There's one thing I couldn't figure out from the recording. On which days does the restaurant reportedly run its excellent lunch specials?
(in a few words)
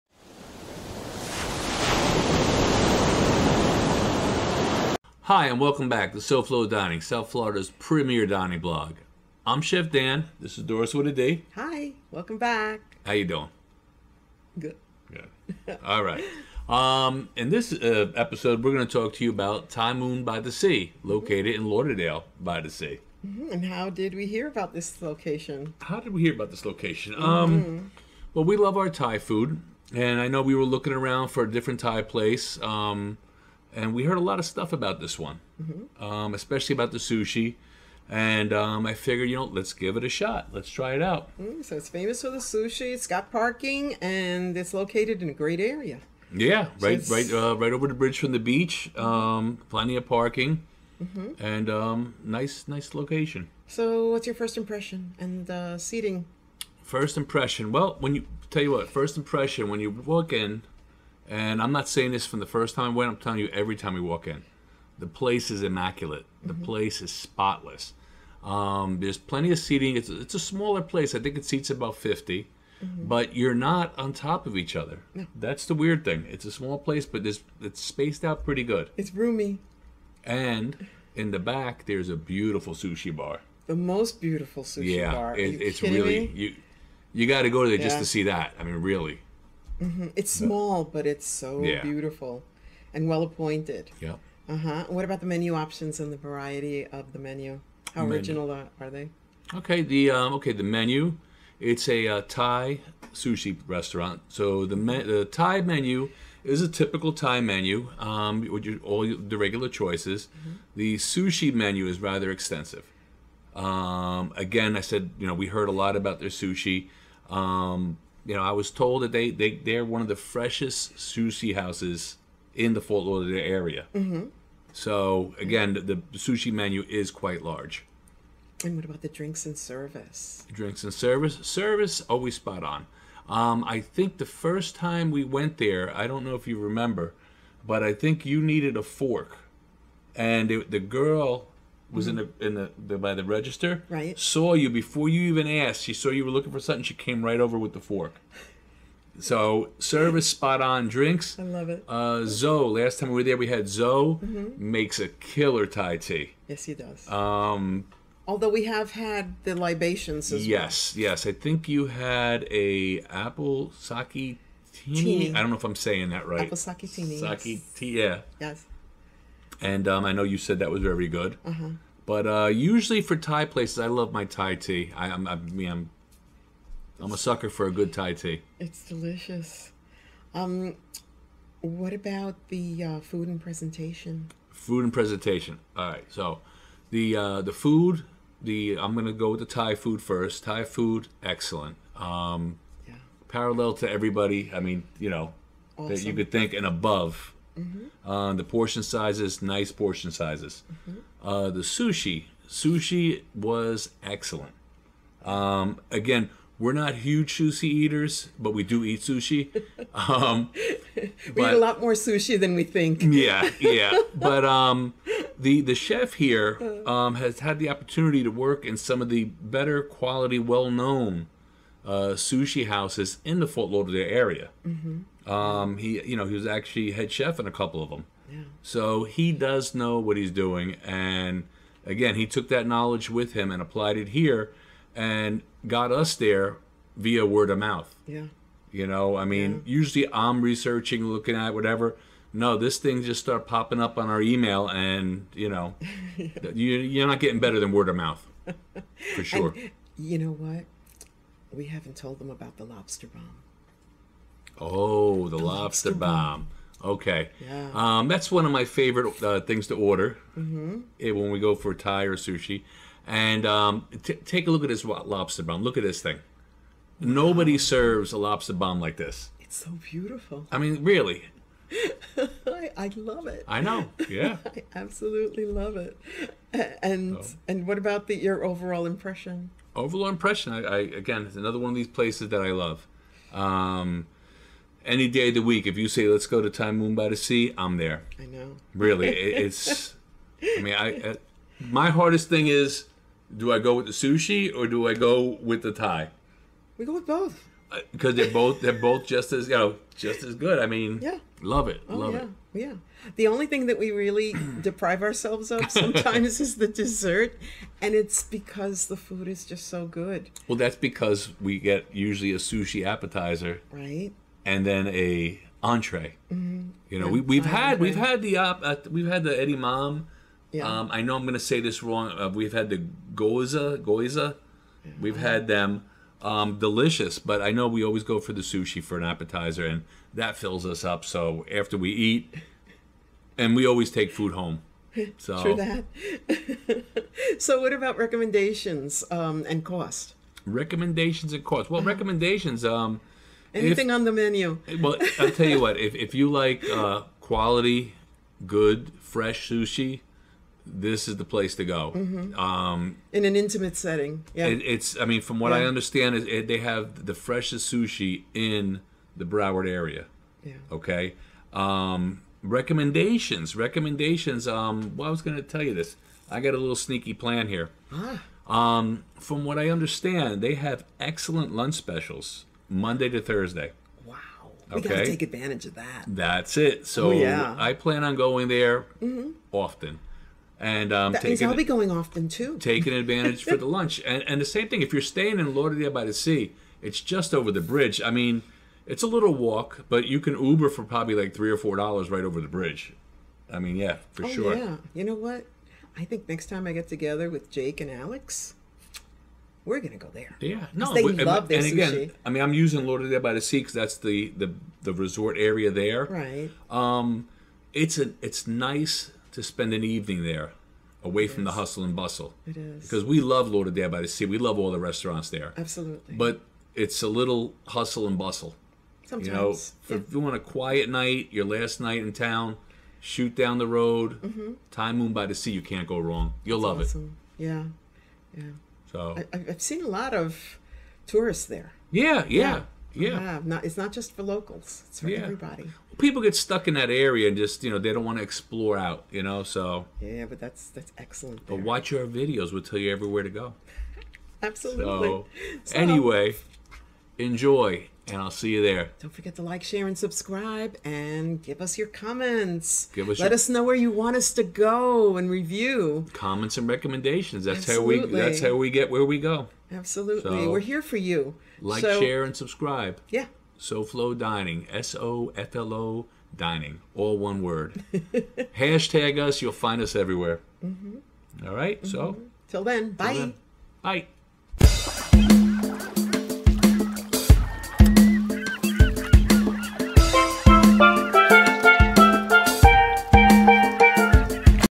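Monday to Thursday.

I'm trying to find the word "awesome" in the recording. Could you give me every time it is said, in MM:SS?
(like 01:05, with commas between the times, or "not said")
03:15, 07:06.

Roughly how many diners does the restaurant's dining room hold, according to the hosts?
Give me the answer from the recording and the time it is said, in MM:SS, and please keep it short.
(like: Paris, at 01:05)
50, at 01:11.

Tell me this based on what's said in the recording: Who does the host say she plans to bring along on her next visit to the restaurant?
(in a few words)
Jake and Alex.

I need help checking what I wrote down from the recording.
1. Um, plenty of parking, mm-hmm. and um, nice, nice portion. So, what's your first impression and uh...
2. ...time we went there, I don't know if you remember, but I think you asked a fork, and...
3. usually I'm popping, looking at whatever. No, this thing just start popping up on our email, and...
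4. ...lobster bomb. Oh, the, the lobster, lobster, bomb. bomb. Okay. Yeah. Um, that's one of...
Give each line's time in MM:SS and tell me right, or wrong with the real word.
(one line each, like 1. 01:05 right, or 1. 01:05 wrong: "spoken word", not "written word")
1. 00:48 wrong: "location", not "portion"
2. 02:14 wrong: "needed", not "asked"
3. 03:59 wrong: "researching", not "popping"
4. 04:12 right.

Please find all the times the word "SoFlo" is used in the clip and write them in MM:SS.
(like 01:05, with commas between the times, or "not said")
00:06, 07:43.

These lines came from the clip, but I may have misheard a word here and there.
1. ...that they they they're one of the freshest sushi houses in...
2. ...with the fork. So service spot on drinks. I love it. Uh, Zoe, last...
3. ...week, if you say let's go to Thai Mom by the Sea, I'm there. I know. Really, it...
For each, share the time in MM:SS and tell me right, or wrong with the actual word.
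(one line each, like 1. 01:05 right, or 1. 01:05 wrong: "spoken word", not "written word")
1. 01:59 right
2. 02:27 right
3. 04:45 wrong: "Moon", not "Mom".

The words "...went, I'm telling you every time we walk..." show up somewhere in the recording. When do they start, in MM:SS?
01:02.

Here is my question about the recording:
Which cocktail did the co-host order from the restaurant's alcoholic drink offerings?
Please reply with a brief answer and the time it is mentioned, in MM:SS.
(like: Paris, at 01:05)
apple saketini, at 02:46.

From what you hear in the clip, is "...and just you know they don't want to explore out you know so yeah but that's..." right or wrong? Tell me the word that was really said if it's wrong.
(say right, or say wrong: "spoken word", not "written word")
right.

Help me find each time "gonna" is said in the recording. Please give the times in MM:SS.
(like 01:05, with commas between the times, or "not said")
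03:08, 06:39.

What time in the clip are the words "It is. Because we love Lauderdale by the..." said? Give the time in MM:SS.
06:52.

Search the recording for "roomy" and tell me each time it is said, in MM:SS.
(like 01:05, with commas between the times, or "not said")
01:19.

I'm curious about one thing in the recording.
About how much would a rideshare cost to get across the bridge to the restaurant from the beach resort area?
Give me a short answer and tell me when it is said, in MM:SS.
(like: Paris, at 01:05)
3 or 4 dollars, at 06:31.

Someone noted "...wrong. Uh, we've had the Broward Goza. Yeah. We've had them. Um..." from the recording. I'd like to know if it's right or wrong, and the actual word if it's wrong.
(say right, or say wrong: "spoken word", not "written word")
wrong: "Goza", not "Broward".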